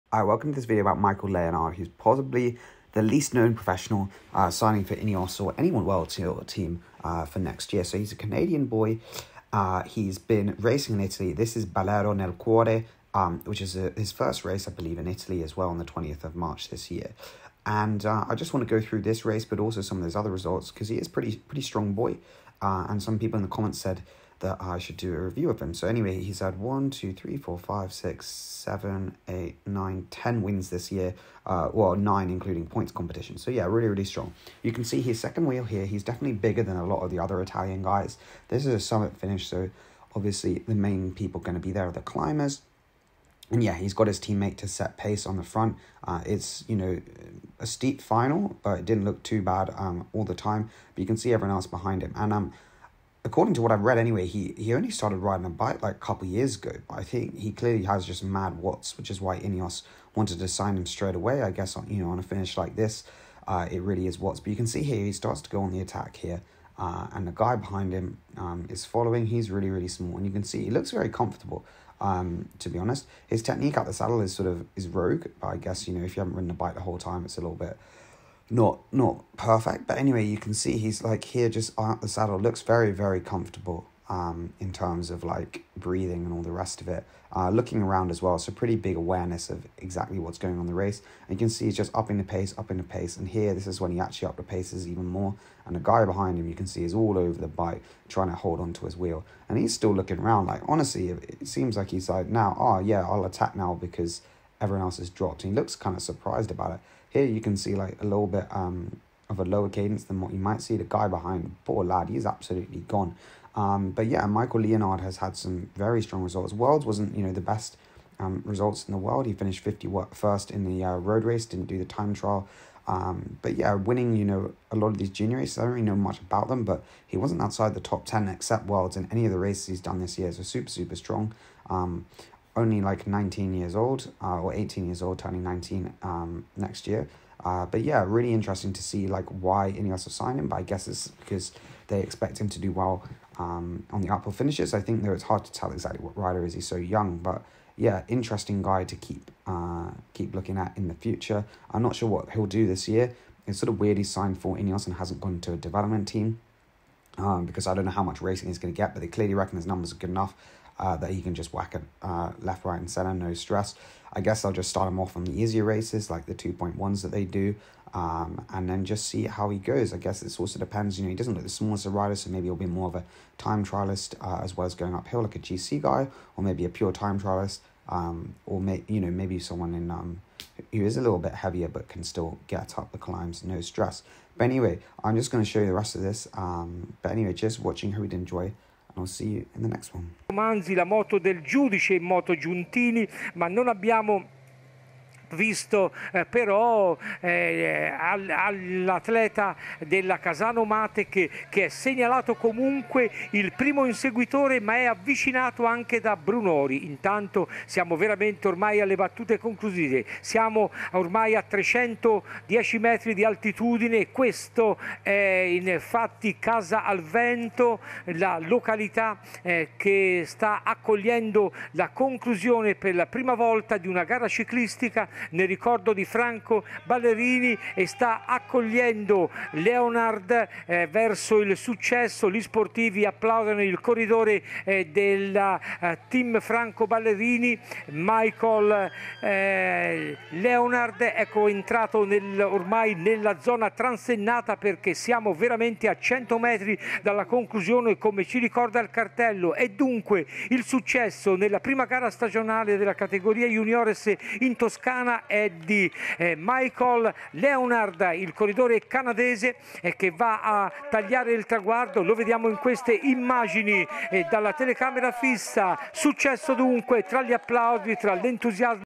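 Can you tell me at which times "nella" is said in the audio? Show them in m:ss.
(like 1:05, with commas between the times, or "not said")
4:02, 4:11.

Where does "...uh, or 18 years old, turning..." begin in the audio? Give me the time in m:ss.
2:14.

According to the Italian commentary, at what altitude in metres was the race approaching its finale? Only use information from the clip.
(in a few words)
310 metres.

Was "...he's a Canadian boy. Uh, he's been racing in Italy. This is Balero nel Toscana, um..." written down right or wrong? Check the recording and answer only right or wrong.
wrong.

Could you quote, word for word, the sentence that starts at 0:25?
So anyway, he's had one, two, three, four, five, six, seven, eight, nine, ten wins this year.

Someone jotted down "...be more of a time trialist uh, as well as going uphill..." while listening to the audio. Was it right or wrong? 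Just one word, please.
right.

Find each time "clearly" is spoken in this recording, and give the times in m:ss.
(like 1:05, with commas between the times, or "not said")
0:57, 2:39.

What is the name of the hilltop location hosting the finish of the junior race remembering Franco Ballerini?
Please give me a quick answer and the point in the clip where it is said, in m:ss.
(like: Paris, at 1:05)
Casa al Vento, at 3:36.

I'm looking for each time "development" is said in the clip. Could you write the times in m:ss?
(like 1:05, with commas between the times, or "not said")
2:35.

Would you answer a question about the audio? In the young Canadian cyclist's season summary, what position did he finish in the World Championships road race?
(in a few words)
51st.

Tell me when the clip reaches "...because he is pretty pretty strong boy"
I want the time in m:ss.
0:20.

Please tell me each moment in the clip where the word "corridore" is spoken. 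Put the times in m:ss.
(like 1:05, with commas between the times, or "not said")
3:53, 4:18.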